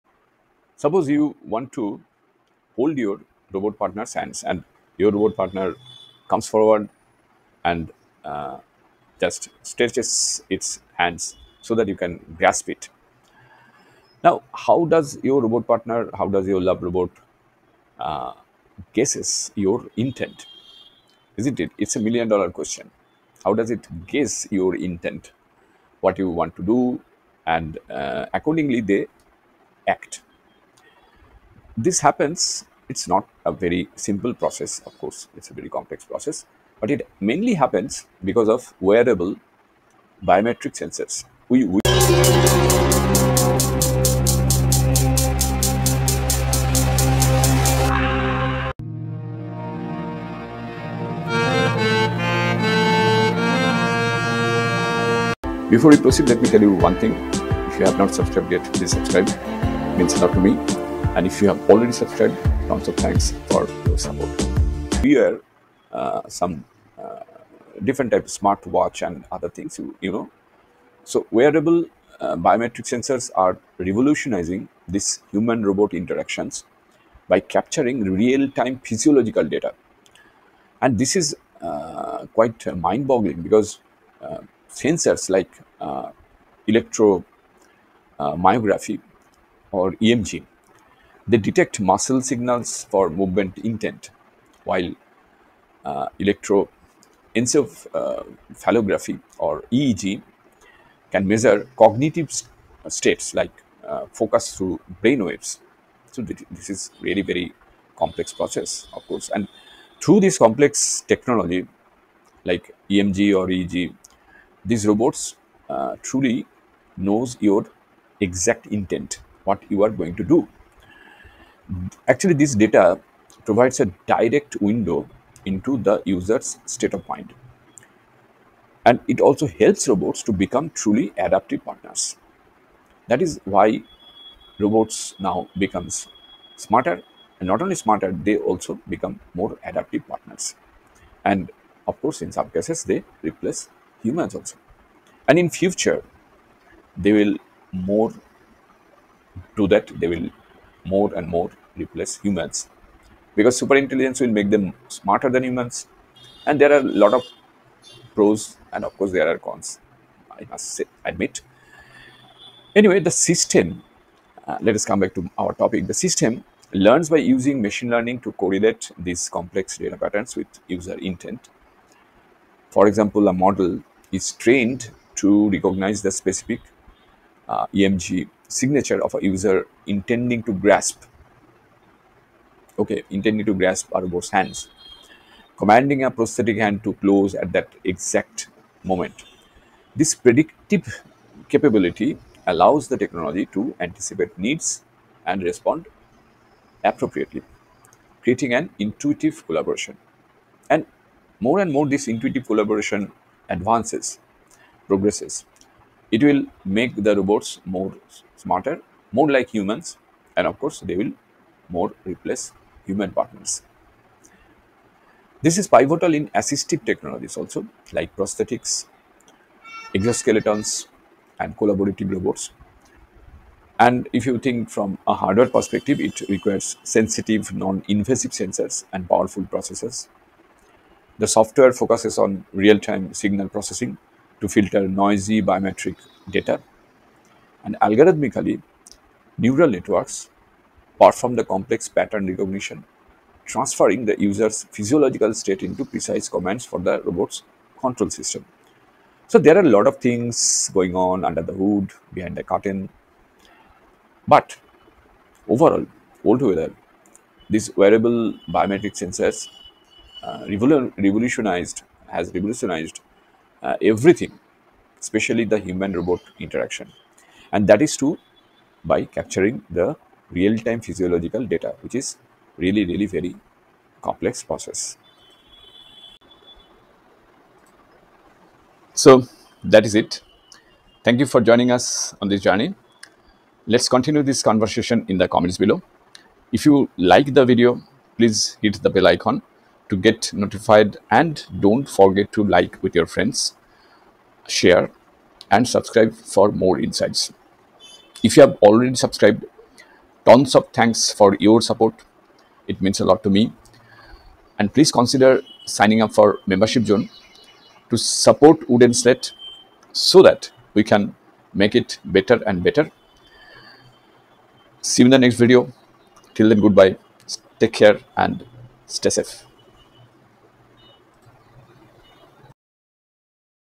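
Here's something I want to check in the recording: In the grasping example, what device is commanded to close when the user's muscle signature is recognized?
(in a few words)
A prosthetic hand.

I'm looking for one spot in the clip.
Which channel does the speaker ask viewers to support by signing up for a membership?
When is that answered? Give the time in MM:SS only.
05:08.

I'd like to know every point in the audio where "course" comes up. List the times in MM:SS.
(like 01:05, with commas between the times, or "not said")
00:34, 01:49, 02:22, 02:38, 03:30.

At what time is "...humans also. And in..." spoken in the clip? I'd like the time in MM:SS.
02:24.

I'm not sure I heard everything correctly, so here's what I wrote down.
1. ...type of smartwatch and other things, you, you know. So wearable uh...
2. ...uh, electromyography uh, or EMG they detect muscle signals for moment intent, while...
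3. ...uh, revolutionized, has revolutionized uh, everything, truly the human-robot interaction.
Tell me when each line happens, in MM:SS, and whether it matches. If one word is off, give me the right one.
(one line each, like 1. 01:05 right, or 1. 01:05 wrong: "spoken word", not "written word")
1. 01:08 right
2. 01:25 wrong: "movement", not "moment"
3. 04:20 wrong: "especially", not "truly".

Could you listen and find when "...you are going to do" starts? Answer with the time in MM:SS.
01:59.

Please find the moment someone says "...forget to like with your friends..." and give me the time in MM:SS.
04:51.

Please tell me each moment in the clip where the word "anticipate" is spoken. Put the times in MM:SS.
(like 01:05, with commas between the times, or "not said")
03:13.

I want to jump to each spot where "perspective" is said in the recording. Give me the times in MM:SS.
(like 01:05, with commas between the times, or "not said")
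03:45.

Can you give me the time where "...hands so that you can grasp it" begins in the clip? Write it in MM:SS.
00:10.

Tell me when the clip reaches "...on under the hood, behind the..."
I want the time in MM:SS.
04:10.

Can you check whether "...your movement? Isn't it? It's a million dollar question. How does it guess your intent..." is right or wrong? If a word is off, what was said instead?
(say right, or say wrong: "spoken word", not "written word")
wrong: "intent", not "movement".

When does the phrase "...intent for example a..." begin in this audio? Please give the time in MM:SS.
02:51.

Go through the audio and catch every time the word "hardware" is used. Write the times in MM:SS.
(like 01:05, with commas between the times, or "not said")
03:45.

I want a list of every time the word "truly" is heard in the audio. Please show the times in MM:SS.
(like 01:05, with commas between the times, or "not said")
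01:56, 02:10.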